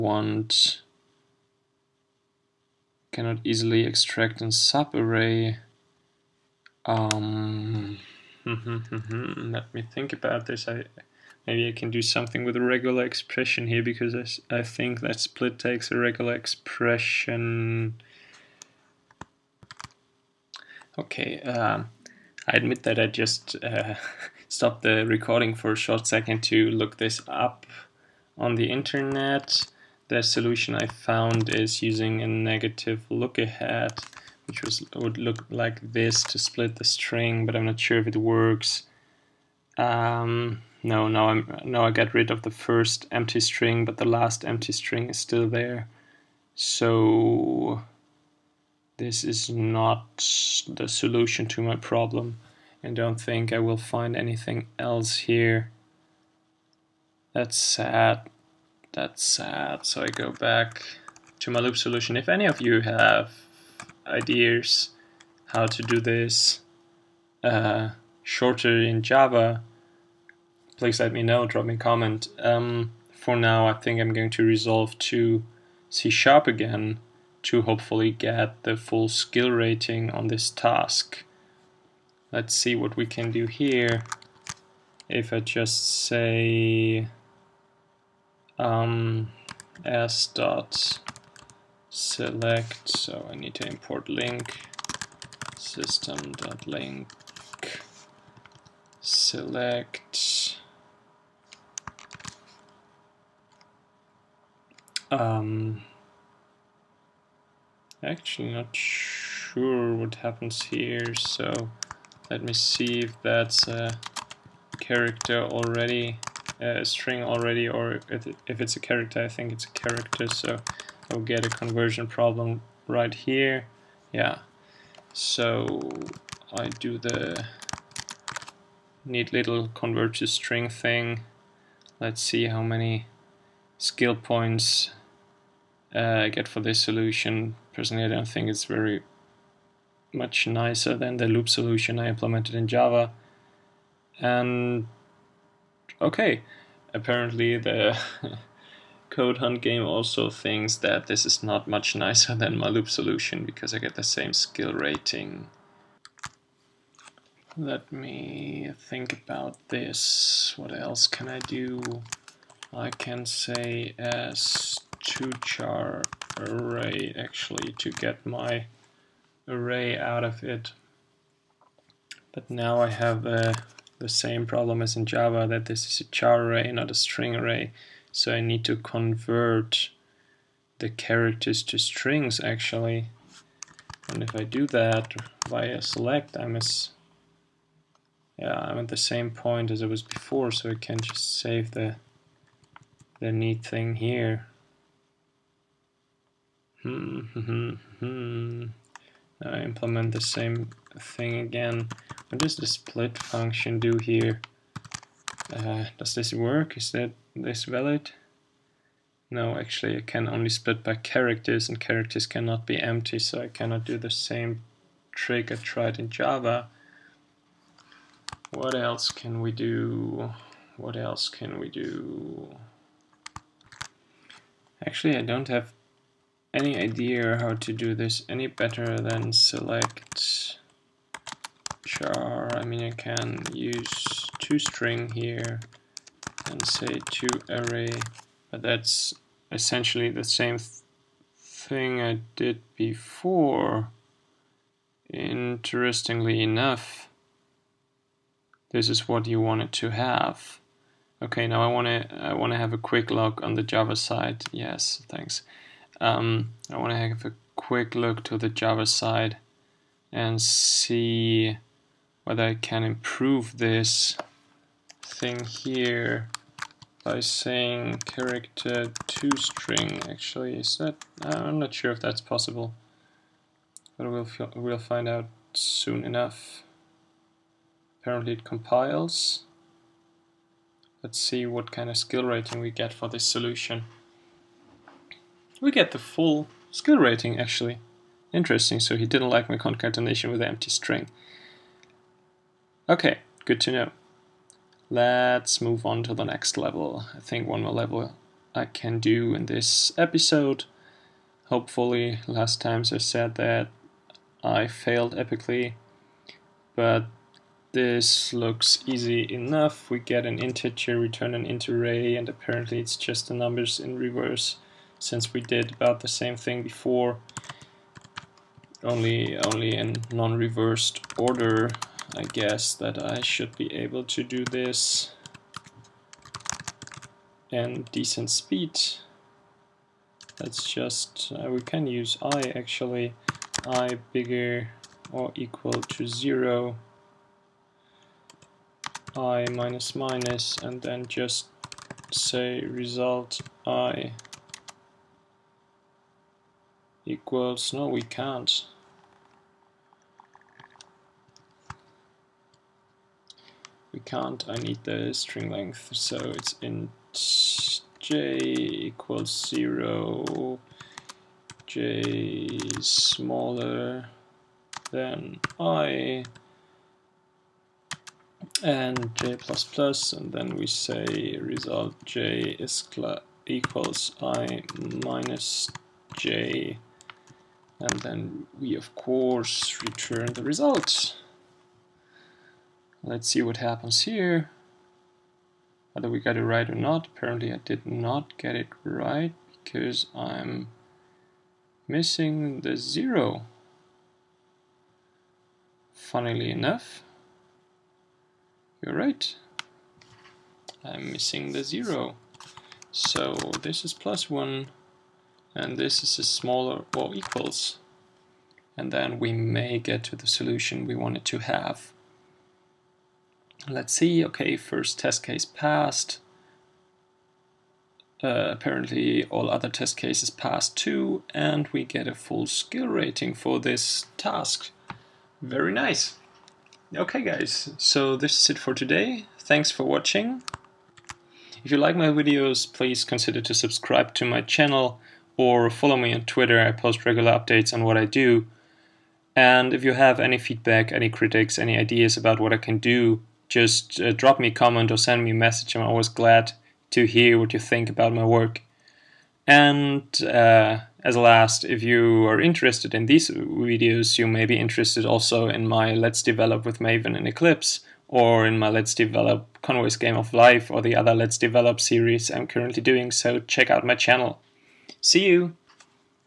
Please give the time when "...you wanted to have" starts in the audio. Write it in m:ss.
4:09.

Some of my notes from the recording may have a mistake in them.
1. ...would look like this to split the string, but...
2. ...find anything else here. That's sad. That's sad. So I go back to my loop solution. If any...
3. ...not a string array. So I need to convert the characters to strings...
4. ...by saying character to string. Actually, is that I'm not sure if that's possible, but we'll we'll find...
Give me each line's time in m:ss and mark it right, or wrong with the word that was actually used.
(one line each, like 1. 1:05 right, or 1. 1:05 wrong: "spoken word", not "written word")
1. 0:34 right
2. 0:53 right
3. 2:56 right
4. 4:27 right.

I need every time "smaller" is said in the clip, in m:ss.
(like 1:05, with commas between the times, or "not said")
6:02, 6:46.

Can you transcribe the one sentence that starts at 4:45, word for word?
We get the full skill rating actually.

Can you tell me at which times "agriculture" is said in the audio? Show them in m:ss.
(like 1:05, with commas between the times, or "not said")
not said.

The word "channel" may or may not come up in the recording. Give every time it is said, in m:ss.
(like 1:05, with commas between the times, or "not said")
7:14, 7:43.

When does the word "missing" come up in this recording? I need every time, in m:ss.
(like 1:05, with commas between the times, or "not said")
6:31, 6:41.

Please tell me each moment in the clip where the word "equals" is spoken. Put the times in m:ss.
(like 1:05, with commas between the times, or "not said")
5:35, 5:47, 5:58, 6:13, 6:47.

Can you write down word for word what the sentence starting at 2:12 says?
Let's see how many skill points uh, I get for this solution.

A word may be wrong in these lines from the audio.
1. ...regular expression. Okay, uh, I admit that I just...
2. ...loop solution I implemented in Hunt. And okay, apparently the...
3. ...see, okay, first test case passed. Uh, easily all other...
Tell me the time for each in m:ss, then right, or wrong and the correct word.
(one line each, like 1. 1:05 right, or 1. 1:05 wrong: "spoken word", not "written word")
1. 0:15 right
2. 2:21 wrong: "Java", not "Hunt"
3. 6:53 wrong: "apparently", not "easily".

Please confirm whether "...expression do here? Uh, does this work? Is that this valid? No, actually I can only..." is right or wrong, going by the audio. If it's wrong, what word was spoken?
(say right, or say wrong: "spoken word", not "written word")
wrong: "function", not "expression".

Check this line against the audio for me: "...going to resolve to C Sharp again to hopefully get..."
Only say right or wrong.
right.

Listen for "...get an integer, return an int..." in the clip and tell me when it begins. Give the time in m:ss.
5:10.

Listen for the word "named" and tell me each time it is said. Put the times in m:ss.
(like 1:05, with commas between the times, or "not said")
not said.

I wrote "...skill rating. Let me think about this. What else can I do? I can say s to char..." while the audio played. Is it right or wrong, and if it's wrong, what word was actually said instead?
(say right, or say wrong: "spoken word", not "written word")
right.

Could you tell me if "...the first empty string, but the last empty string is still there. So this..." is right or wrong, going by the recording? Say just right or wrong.
right.